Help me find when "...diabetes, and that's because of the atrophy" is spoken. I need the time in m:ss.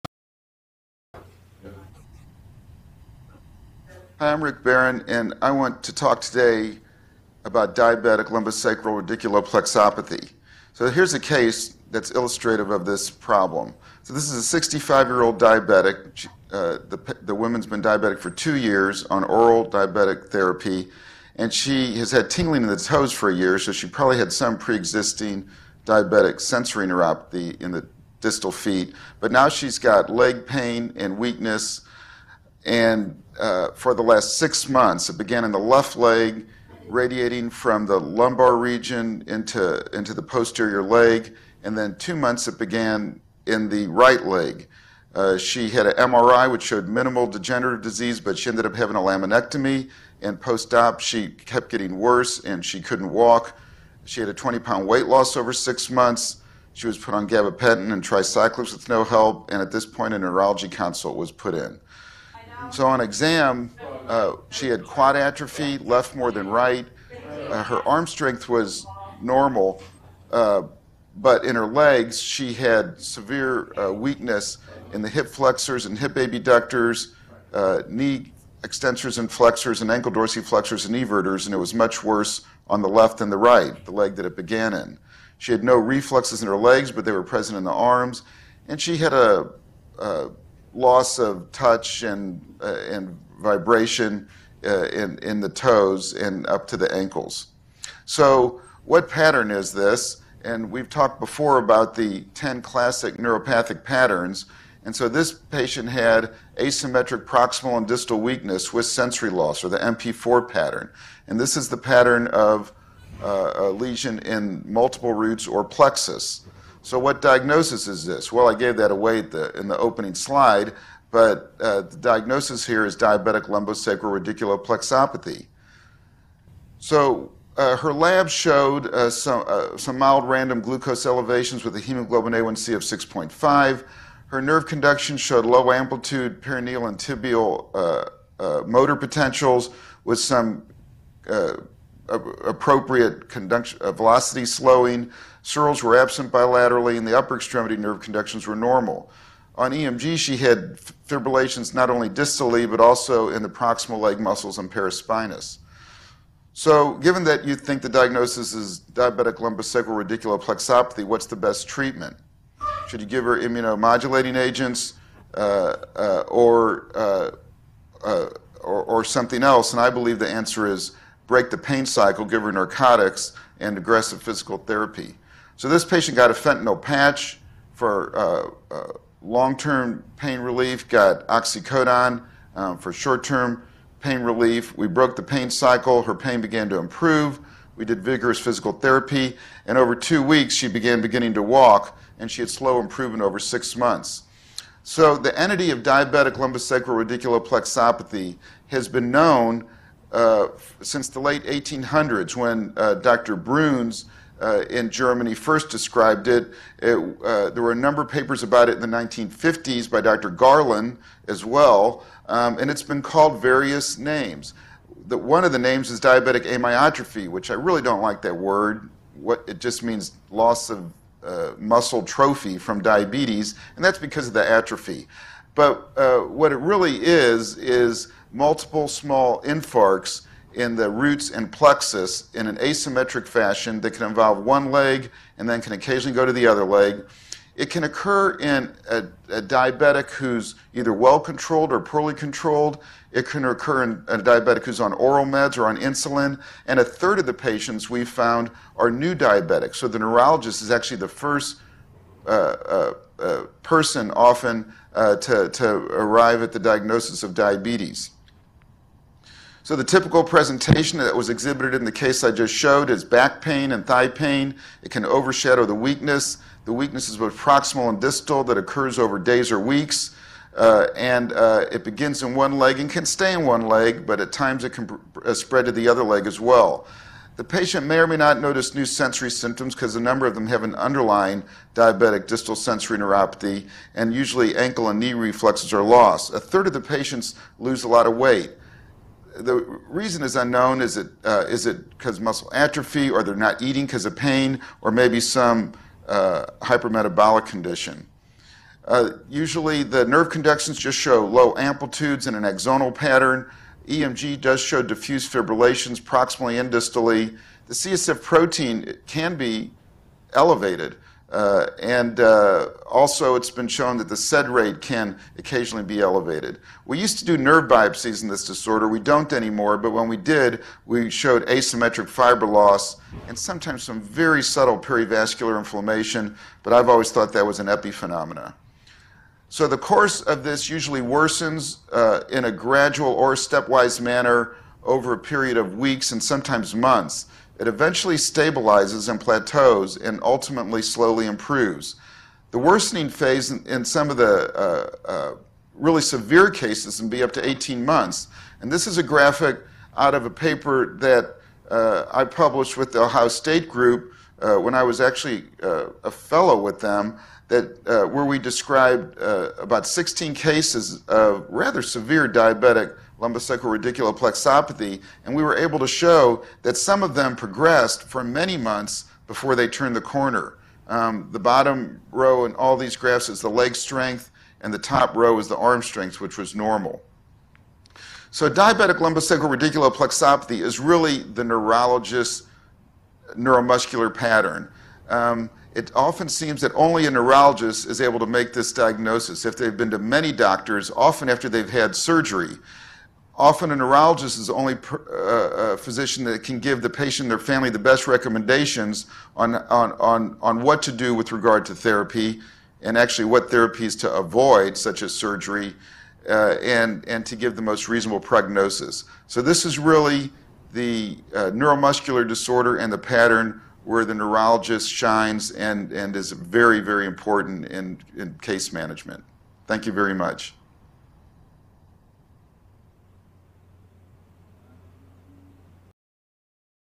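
3:42.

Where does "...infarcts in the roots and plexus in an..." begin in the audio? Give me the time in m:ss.
3:49.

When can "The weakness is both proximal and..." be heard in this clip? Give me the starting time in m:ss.
4:26.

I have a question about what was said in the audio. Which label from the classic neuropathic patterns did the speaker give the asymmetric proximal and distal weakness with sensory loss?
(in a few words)
MP4.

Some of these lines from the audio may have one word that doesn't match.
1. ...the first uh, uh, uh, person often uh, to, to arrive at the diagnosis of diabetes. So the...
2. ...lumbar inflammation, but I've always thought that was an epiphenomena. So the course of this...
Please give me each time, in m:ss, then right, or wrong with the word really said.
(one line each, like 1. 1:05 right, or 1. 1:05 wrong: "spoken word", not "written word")
1. 4:10 right
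2. 5:24 wrong: "perivascular", not "lumbar".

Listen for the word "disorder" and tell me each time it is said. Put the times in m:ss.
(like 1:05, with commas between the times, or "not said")
5:18, 6:52.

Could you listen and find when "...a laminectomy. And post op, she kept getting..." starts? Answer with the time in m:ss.
0:48.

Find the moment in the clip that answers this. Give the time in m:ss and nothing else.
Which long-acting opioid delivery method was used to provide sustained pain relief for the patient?
2:56.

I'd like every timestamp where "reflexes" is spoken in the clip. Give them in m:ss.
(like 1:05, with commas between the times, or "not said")
1:25, 4:45.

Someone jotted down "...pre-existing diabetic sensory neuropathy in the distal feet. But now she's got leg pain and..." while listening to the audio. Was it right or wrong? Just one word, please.
right.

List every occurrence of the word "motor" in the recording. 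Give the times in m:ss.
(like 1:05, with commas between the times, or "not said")
2:18.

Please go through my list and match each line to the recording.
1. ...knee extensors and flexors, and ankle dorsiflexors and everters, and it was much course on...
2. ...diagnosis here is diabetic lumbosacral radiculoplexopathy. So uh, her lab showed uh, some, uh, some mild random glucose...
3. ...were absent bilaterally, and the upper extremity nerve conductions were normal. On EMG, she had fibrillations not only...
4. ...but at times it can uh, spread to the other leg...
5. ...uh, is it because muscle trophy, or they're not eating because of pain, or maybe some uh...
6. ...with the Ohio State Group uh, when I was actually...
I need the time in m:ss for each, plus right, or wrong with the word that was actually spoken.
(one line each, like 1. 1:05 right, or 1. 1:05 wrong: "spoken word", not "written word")
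1. 1:17 wrong: "worse", not "course"
2. 2:01 right
3. 2:25 right
4. 4:34 right
5. 4:51 wrong: "atrophy", not "trophy"
6. 5:52 right.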